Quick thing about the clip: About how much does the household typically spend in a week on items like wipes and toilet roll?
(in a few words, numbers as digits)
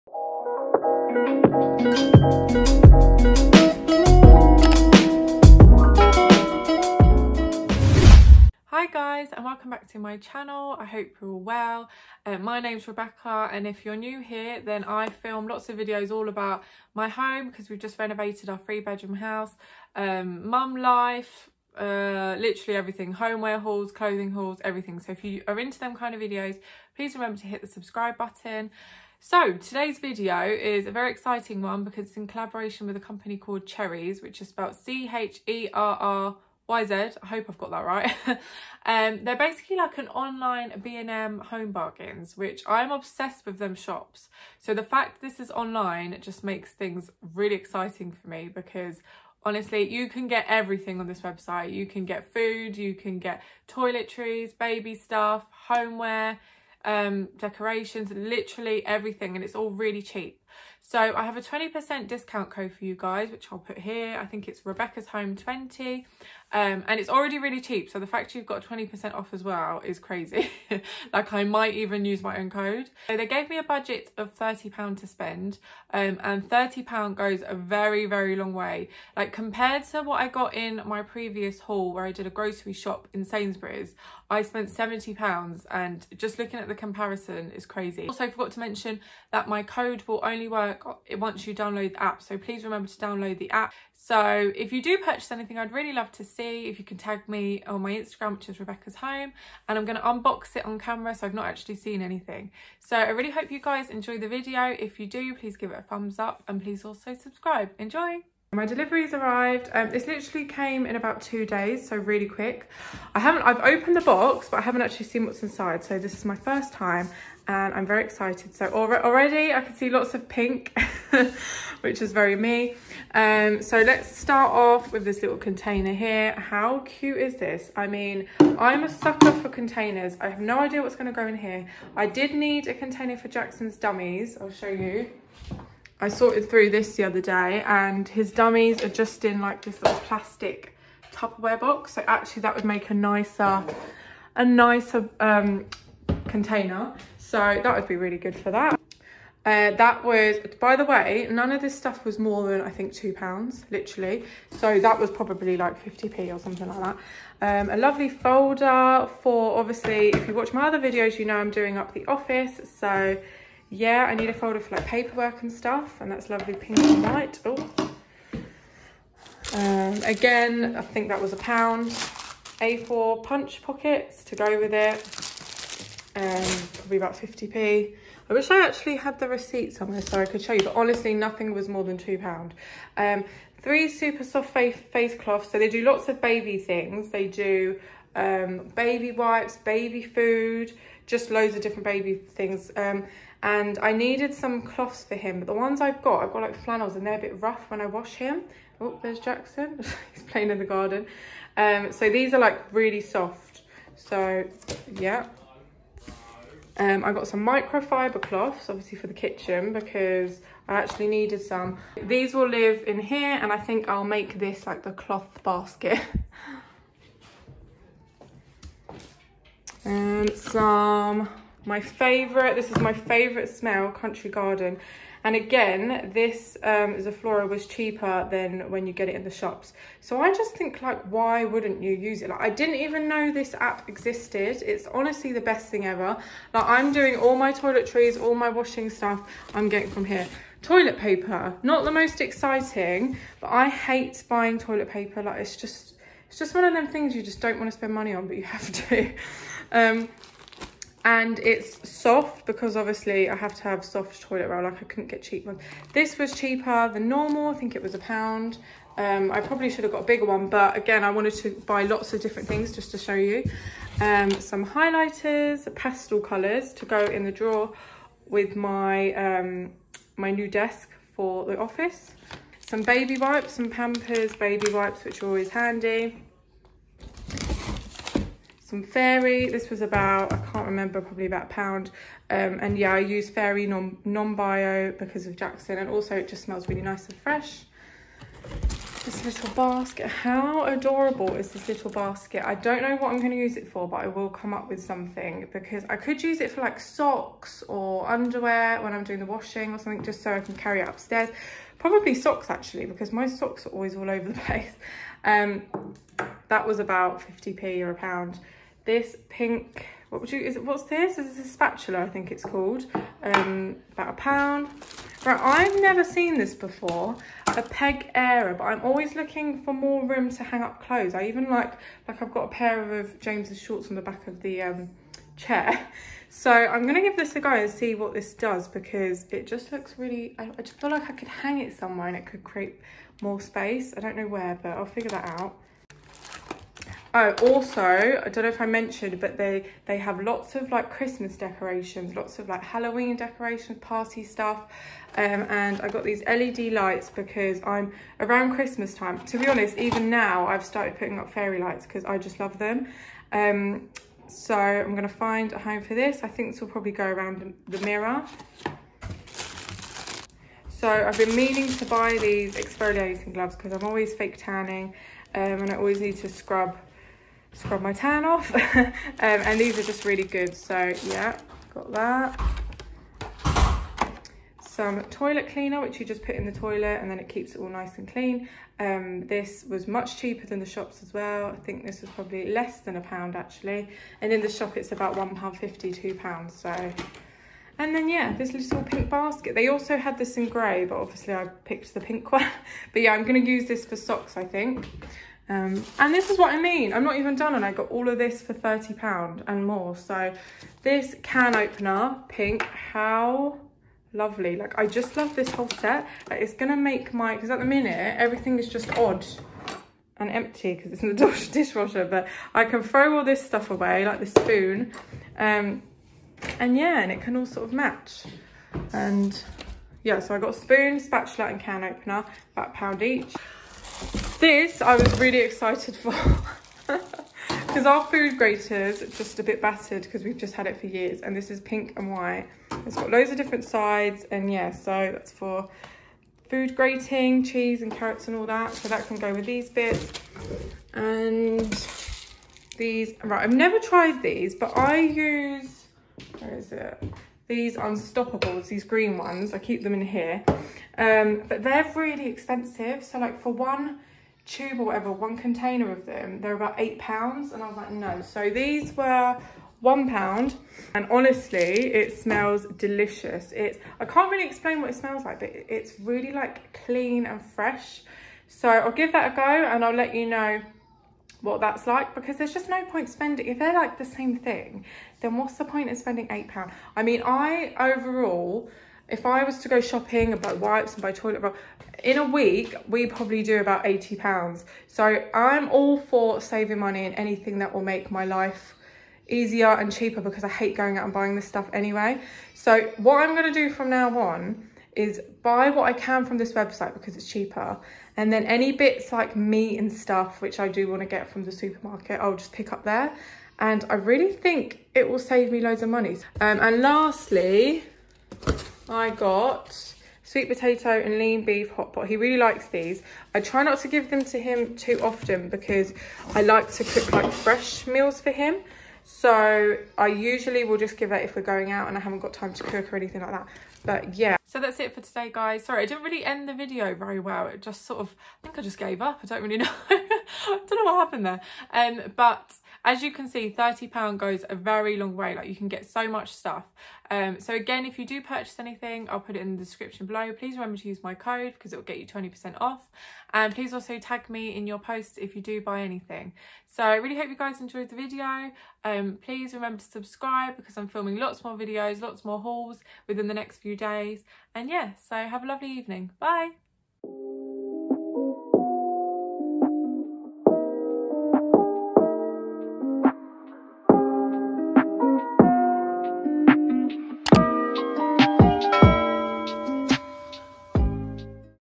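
£80.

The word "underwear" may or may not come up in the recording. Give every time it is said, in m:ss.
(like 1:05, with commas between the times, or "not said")
4:58.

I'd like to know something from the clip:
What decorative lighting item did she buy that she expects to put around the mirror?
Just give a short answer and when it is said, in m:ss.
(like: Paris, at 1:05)
LED lights, at 5:46.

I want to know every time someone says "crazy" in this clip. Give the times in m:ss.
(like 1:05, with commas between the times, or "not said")
1:09, 1:27.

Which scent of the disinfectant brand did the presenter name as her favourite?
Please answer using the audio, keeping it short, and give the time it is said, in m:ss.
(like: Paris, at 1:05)
Country Garden, at 3:43.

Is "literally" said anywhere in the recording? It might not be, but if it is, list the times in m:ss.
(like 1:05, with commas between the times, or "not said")
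0:22, 0:58, 1:50, 2:33.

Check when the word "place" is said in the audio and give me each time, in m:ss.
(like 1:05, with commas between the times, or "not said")
5:04.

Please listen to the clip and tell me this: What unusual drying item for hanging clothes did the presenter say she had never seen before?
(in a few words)
peg airer.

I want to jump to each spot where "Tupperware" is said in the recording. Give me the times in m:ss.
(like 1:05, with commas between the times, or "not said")
2:21.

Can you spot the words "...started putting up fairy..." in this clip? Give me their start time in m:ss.
5:50.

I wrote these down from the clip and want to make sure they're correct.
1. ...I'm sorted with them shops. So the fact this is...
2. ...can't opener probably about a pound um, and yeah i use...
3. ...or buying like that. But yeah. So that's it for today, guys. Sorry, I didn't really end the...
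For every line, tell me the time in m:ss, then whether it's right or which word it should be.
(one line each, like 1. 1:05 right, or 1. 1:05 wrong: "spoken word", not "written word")
1. 0:42 wrong: "obsessed", not "sorted"
2. 4:40 wrong: "remember", not "opener"
3. 8:42 wrong: "anything", not "buying".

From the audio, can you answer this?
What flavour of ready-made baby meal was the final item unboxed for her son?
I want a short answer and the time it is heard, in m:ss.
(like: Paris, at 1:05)
sweet potato and lean beef hot pot, at 8:30.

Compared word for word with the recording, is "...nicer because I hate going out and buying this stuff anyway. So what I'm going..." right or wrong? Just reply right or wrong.
wrong.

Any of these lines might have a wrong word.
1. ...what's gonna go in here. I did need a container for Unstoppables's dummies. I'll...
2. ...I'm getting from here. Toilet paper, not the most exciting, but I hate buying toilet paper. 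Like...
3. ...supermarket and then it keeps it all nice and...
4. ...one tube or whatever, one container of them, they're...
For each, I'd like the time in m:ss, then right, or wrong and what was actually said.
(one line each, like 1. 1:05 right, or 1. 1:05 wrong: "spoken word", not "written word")
1. 2:10 wrong: "Jackson", not "Unstoppables"
2. 3:59 right
3. 6:16 wrong: "toilet", not "supermarket"
4. 7:33 right.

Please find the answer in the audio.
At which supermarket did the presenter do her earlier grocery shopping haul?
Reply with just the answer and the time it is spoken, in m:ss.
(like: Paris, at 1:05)
Sainsbury's, at 1:23.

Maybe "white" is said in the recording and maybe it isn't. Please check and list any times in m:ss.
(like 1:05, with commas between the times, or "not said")
2:47, 7:12.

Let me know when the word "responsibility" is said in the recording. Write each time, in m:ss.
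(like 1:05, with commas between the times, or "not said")
not said.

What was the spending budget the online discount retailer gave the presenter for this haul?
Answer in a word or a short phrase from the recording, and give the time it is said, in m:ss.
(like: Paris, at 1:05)
£30, at 1:14.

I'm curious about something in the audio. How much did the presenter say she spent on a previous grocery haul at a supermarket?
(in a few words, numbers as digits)
£70.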